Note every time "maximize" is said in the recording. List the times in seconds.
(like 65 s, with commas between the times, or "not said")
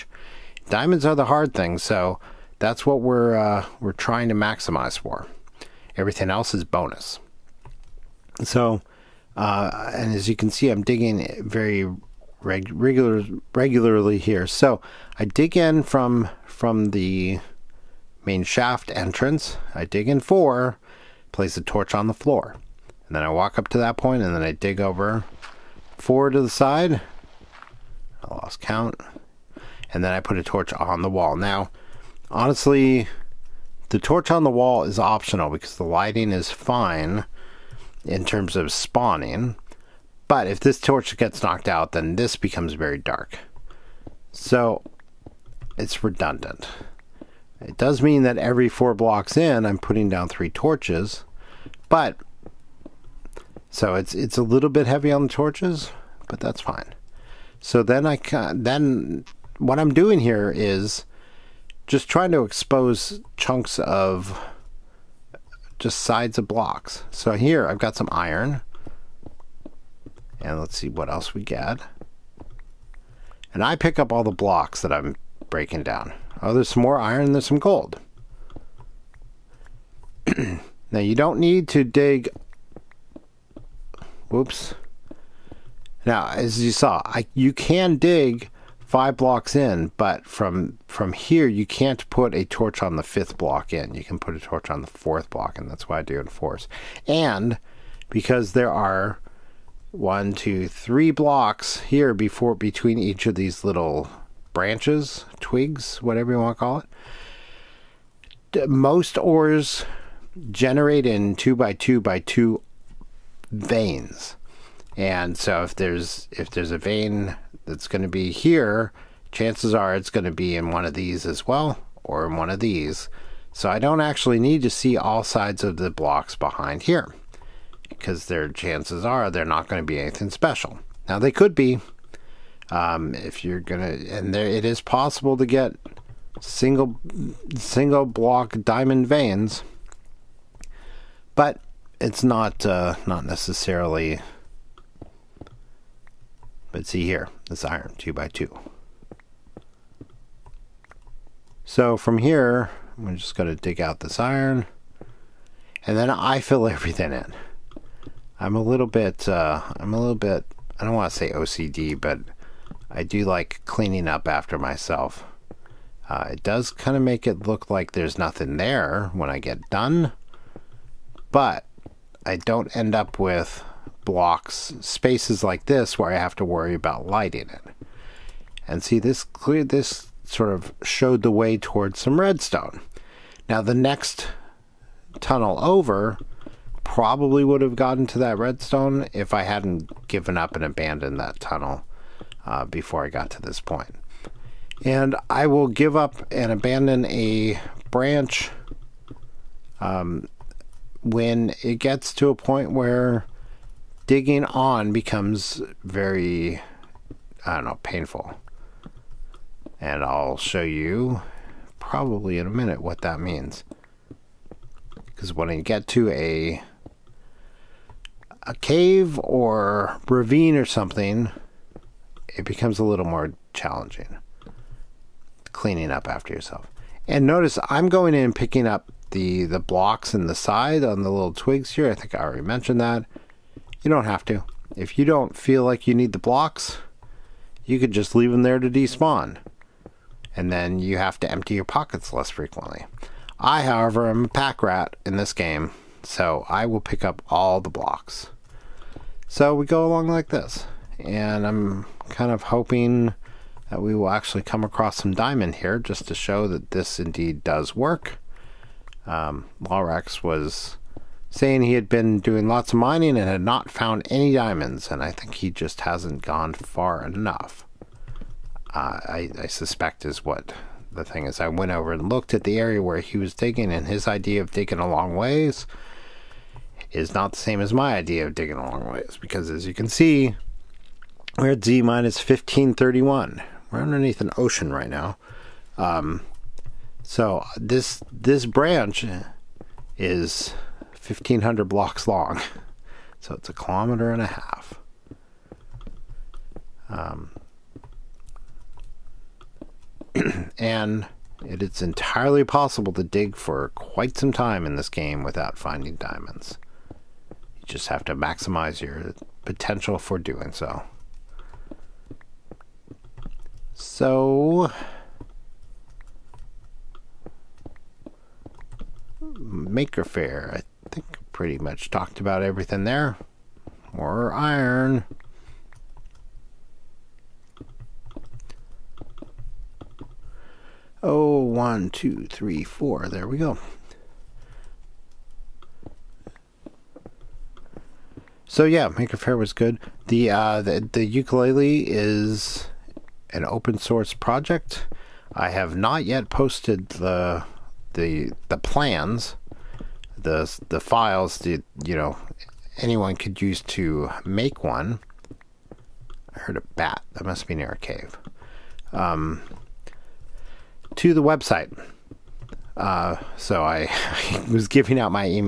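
4 s, 308 s.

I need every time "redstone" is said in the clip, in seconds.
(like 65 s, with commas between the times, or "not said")
182 s, 188 s.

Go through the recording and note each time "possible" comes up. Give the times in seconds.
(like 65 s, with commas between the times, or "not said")
134 s, 302 s.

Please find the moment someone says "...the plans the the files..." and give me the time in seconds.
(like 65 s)
348 s.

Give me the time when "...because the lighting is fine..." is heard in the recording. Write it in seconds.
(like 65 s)
35 s.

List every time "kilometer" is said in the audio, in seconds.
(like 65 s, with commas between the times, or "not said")
293 s.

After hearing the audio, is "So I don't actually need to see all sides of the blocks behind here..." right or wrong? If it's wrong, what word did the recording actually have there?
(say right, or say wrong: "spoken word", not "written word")
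right.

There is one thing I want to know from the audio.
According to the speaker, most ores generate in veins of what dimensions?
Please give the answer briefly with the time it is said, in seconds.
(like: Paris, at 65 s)
2 by 2 by 2, at 111 s.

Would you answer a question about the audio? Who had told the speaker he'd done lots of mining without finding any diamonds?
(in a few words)
Lorax.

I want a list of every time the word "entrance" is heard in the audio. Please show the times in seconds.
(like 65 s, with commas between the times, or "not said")
18 s.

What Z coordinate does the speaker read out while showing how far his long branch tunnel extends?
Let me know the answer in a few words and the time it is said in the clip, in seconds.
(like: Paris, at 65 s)
-1531, at 281 s.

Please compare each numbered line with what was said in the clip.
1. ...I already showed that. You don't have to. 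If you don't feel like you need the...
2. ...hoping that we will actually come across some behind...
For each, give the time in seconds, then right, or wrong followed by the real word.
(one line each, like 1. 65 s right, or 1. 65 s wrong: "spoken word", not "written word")
1. 232 s wrong: "mentioned", not "showed"
2. 252 s wrong: "diamond", not "behind".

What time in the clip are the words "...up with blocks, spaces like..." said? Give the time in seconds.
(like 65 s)
172 s.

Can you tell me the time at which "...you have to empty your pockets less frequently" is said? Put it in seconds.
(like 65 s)
240 s.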